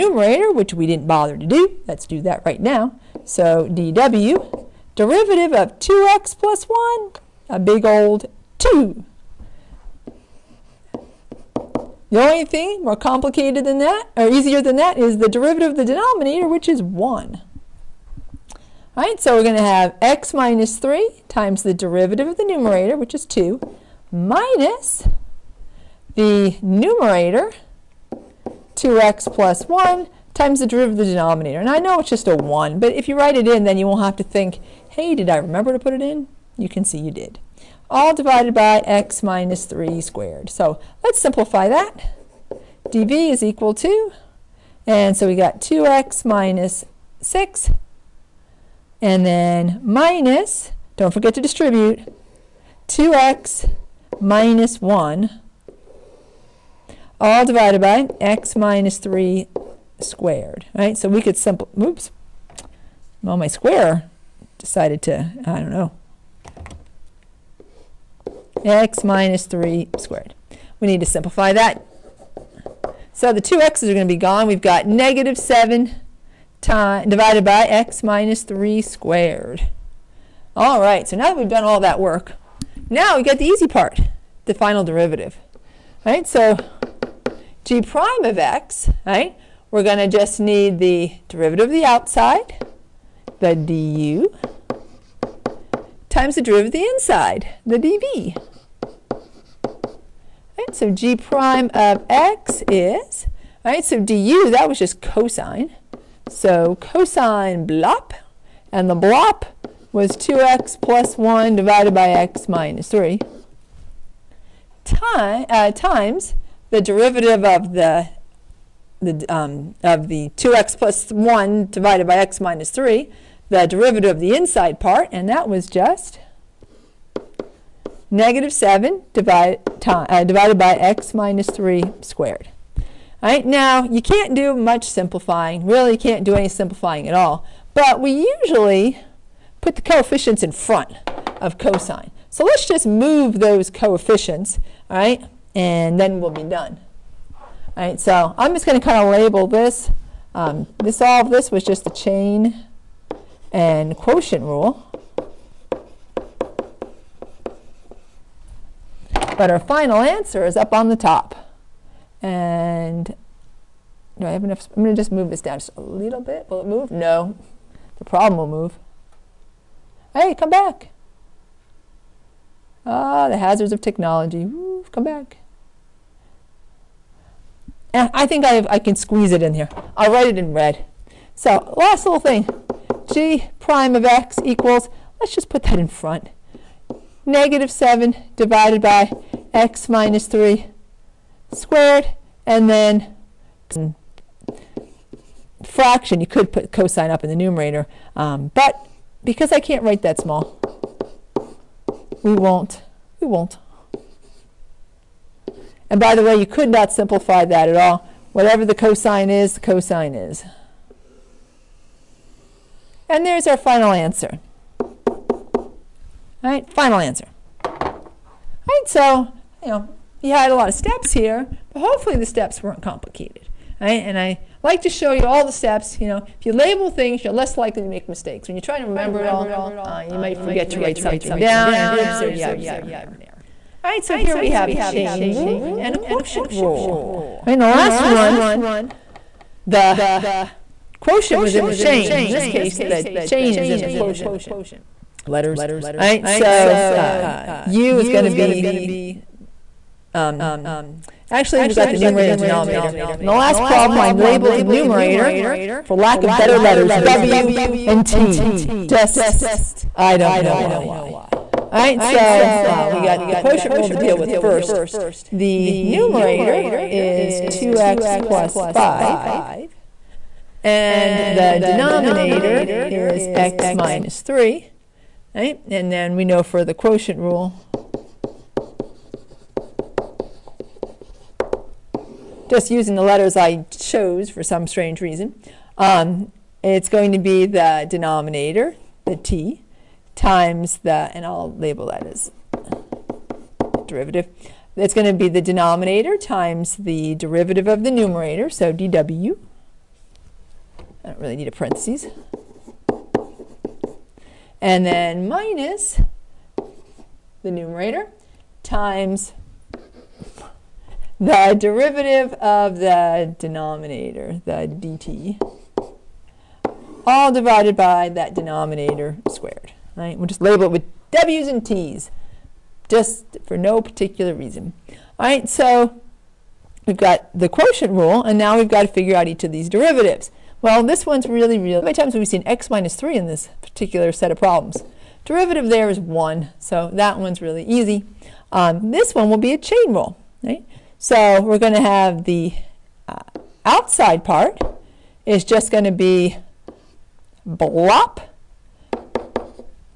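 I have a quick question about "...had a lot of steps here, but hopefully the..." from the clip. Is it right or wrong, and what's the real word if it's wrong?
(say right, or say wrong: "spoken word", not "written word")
right.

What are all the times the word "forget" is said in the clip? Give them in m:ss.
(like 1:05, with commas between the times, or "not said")
0:51, 3:50.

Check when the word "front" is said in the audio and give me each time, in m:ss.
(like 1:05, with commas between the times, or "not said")
2:20, 3:05.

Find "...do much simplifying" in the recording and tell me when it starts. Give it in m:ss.
2:14.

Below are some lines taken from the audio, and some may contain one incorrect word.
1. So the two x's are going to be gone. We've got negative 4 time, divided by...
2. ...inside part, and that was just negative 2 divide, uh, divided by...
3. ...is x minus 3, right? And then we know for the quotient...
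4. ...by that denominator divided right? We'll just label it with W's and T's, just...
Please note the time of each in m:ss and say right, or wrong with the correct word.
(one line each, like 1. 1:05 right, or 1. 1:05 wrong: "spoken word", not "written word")
1. 1:13 wrong: "7", not "4"
2. 2:04 wrong: "7", not "2"
3. 4:32 right
4. 5:17 wrong: "squared", not "divided".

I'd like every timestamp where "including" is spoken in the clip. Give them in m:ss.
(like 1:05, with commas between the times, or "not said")
not said.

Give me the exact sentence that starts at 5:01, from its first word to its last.
I don't really need a parentheses.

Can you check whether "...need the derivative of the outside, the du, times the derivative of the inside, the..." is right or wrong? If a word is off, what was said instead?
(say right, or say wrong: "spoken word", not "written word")
right.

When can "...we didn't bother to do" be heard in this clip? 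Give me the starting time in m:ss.
0:00.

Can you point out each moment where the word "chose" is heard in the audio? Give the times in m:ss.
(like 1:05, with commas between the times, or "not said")
4:43.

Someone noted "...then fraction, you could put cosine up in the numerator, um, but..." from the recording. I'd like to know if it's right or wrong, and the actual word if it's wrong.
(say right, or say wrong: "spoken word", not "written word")
right.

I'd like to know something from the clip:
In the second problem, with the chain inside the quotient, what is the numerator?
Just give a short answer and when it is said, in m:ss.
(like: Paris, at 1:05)
2x + 5, at 4:27.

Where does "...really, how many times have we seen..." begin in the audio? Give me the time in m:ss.
5:31.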